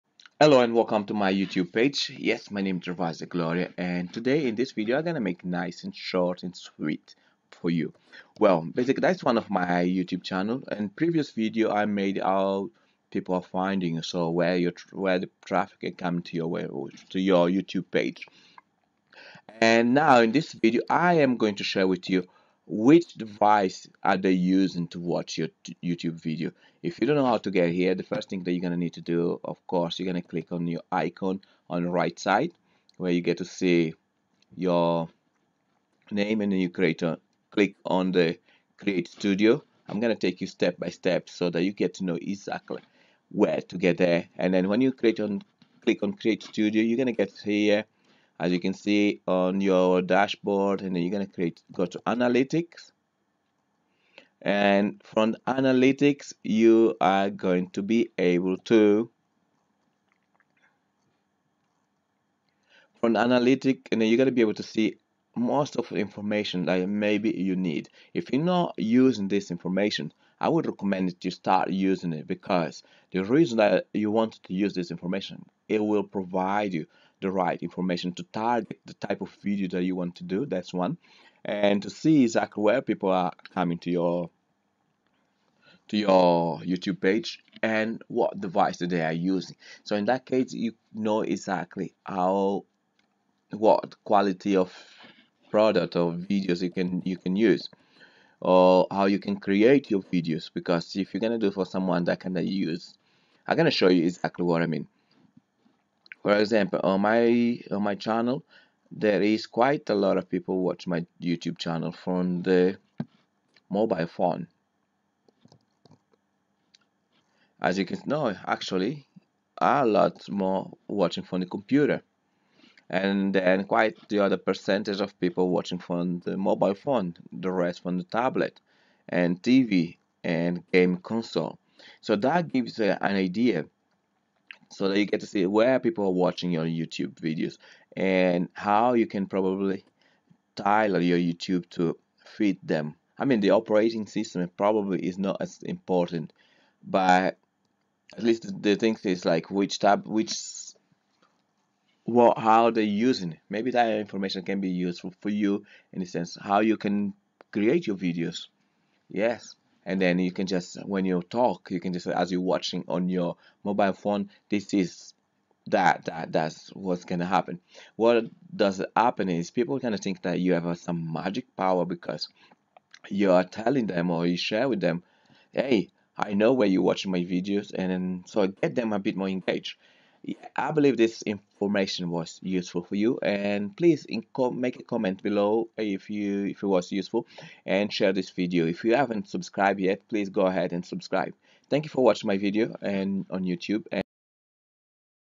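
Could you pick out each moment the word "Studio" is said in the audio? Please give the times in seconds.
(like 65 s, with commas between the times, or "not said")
39 s, 46 s.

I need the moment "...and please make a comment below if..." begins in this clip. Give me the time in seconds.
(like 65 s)
183 s.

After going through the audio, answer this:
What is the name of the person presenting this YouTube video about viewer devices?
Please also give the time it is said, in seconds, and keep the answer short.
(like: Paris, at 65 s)
Gervasio Gloria, at 2 s.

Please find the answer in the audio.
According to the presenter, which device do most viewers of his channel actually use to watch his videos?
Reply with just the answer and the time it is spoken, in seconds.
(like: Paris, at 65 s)
Computer, at 121 s.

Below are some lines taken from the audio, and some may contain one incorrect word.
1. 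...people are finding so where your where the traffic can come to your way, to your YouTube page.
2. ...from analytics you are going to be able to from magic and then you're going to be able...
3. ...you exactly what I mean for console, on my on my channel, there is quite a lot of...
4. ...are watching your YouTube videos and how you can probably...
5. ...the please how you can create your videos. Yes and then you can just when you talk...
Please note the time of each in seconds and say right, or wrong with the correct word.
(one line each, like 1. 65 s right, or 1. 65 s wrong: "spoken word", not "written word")
1. 13 s right
2. 55 s wrong: "analytic", not "magic"
3. 103 s wrong: "example", not "console"
4. 136 s right
5. 155 s wrong: "sense", not "please".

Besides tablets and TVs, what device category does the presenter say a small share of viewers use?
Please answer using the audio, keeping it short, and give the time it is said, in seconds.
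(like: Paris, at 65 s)
Game console, at 130 s.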